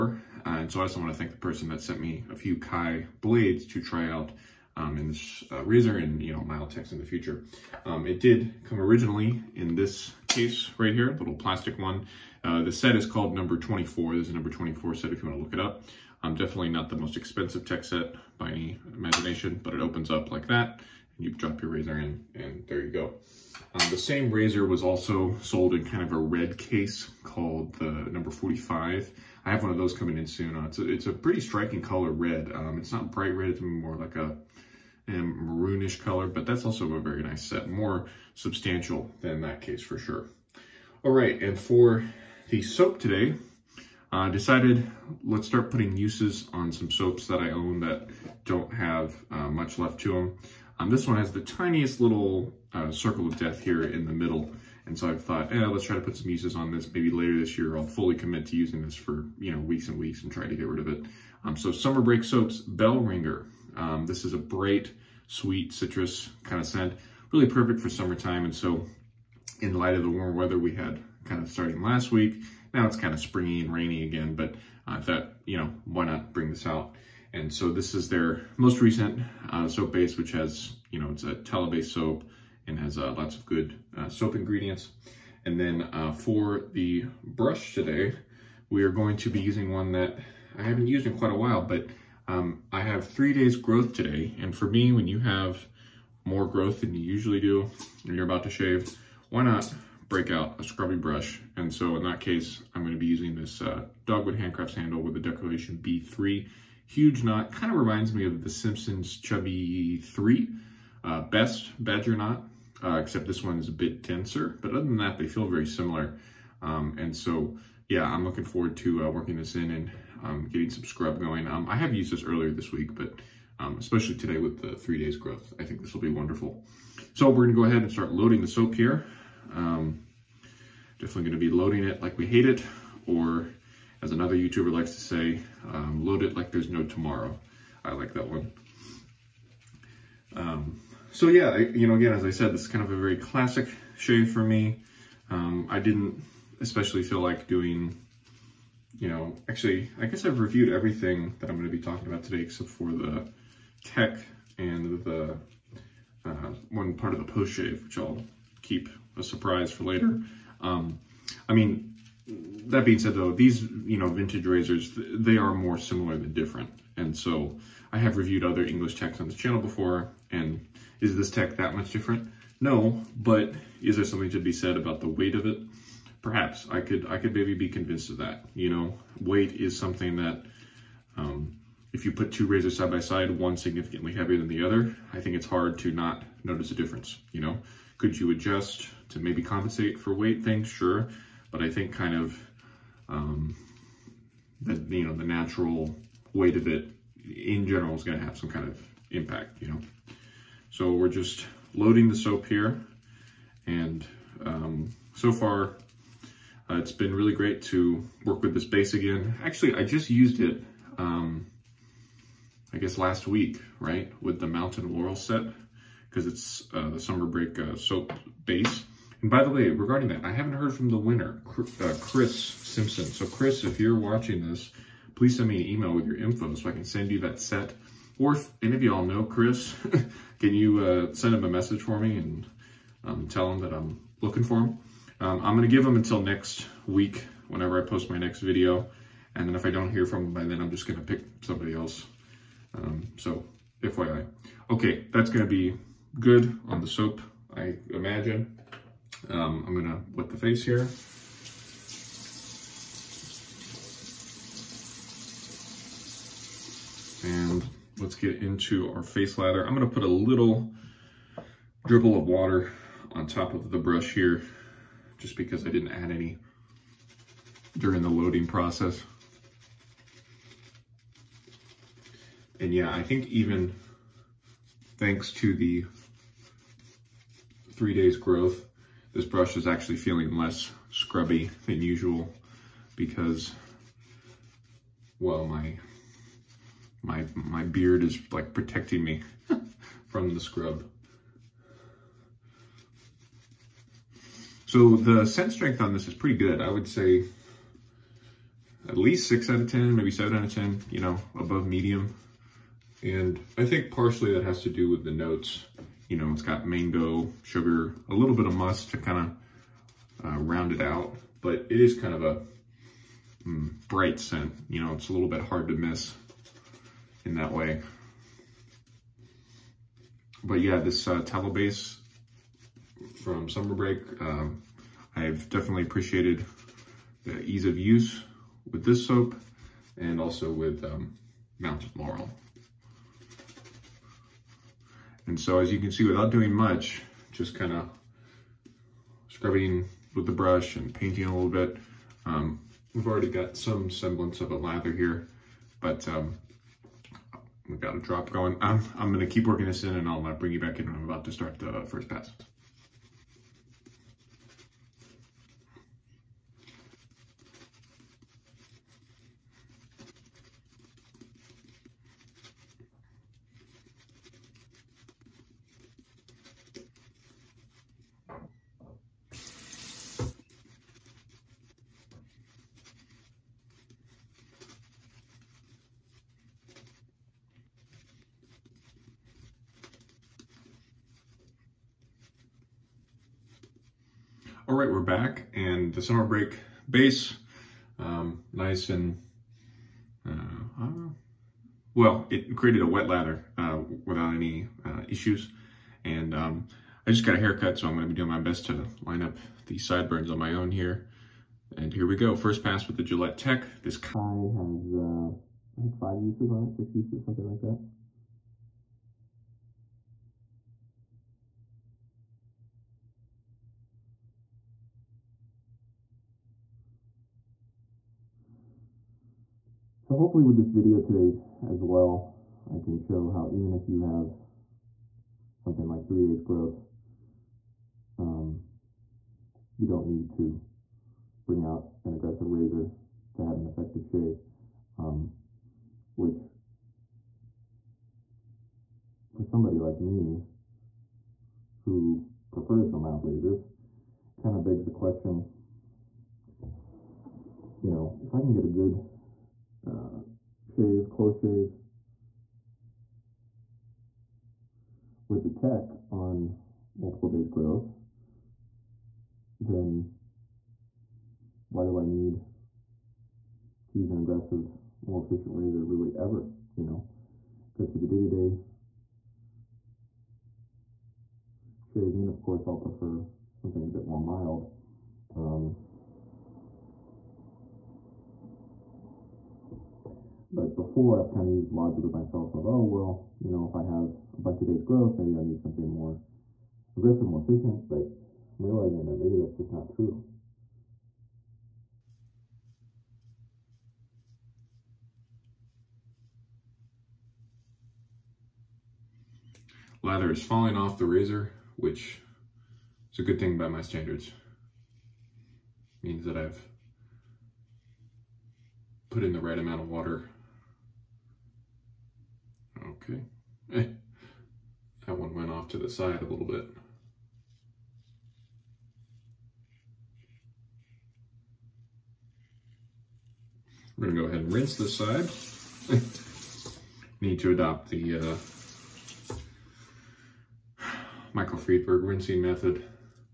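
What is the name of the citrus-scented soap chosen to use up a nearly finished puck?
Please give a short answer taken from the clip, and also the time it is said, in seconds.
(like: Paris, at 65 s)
Bell Ringer, at 62 s.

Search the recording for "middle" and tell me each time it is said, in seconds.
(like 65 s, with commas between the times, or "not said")
54 s.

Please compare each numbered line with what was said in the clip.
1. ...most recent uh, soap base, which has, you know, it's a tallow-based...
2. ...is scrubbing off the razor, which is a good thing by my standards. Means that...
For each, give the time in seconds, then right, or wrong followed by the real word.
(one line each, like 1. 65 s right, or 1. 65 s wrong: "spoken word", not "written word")
1. 78 s right
2. 500 s wrong: "falling", not "scrubbing".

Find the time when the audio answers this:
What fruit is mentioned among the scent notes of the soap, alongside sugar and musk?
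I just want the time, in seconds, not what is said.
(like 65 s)
306 s.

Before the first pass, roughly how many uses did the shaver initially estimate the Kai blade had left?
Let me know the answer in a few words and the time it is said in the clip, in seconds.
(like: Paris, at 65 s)
5, at 405 s.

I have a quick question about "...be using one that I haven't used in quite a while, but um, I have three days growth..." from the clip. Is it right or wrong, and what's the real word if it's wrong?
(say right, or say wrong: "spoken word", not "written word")
right.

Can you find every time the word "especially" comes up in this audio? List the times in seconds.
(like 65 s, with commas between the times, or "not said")
123 s, 146 s.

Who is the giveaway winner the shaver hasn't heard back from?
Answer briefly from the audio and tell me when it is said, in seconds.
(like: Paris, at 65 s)
Chris Simpson, at 222 s.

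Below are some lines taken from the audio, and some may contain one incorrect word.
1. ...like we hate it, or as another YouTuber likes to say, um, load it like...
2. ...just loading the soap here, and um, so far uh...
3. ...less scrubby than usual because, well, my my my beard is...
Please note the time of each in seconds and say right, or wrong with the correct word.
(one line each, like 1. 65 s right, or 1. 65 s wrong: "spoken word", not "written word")
1. 132 s right
2. 201 s right
3. 280 s right.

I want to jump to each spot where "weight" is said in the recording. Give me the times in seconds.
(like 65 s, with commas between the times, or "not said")
175 s, 179 s, 190 s, 196 s.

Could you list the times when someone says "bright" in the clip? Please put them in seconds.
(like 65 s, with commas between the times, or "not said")
33 s, 64 s, 313 s.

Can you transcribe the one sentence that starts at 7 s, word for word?
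Um, it did come originally in this case right here, little plastic one.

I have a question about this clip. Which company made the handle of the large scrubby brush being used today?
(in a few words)
Dogwood Handcrafts.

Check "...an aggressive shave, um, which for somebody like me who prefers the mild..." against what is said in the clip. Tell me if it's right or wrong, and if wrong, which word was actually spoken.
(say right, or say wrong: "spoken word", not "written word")
wrong: "effective", not "aggressive".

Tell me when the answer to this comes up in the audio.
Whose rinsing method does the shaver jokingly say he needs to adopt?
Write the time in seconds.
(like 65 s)
531 s.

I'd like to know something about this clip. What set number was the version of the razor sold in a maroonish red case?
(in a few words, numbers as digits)
45.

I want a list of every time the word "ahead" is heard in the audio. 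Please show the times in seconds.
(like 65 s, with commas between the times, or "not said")
127 s, 524 s.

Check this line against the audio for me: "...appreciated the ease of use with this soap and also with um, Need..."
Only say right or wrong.
wrong.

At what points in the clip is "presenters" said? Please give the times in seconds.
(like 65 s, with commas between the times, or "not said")
not said.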